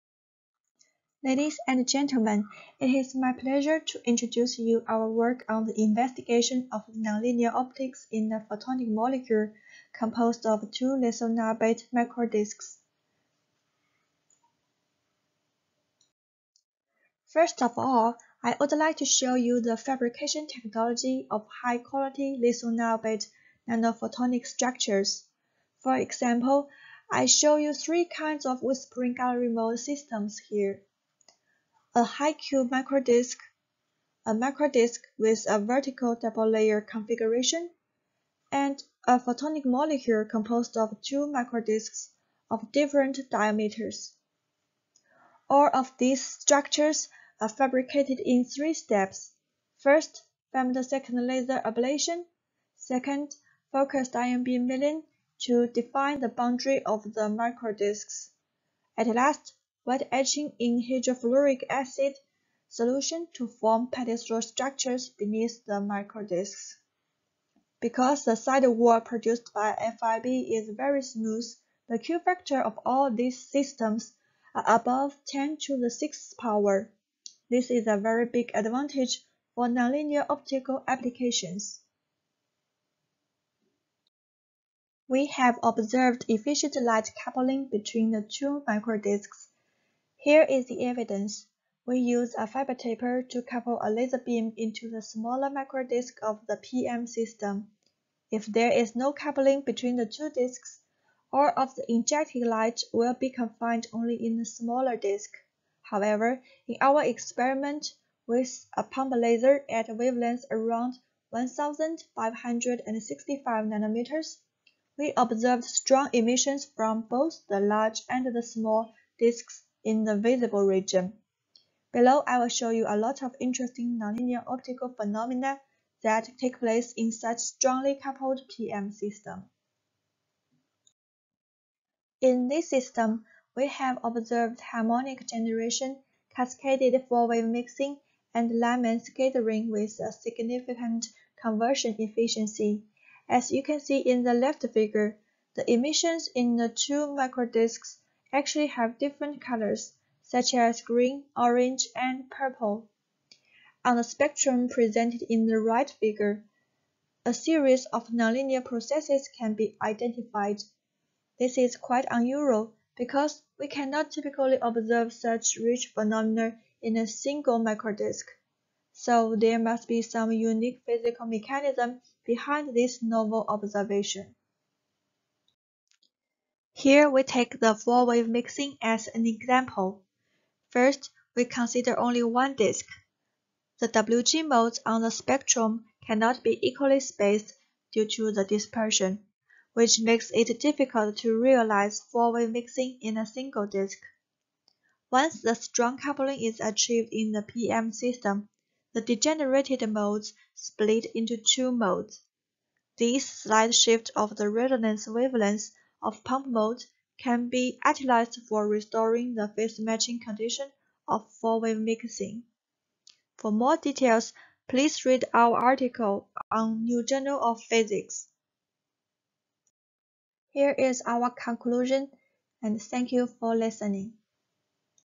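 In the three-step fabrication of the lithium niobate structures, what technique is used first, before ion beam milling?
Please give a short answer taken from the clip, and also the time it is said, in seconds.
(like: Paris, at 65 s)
femtosecond laser ablation, at 50 s.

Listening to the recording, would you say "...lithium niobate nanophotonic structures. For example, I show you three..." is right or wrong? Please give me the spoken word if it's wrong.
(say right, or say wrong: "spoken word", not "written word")
right.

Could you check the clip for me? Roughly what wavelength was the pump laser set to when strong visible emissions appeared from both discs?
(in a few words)
1565 nanometers.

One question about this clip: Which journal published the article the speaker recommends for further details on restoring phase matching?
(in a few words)
New Journal of Physics.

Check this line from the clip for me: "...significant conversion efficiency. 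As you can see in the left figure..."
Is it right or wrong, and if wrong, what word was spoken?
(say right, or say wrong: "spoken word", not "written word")
right.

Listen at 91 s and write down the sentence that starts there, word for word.
We use a fiber taper to couple a laser beam into the smaller disk of the PM system.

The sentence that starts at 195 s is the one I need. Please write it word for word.
Once the strong coupling is achieved in the PM system, the degenerated modes split into two modes.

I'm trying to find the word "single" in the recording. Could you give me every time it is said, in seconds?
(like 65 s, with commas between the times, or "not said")
167 s, 193 s.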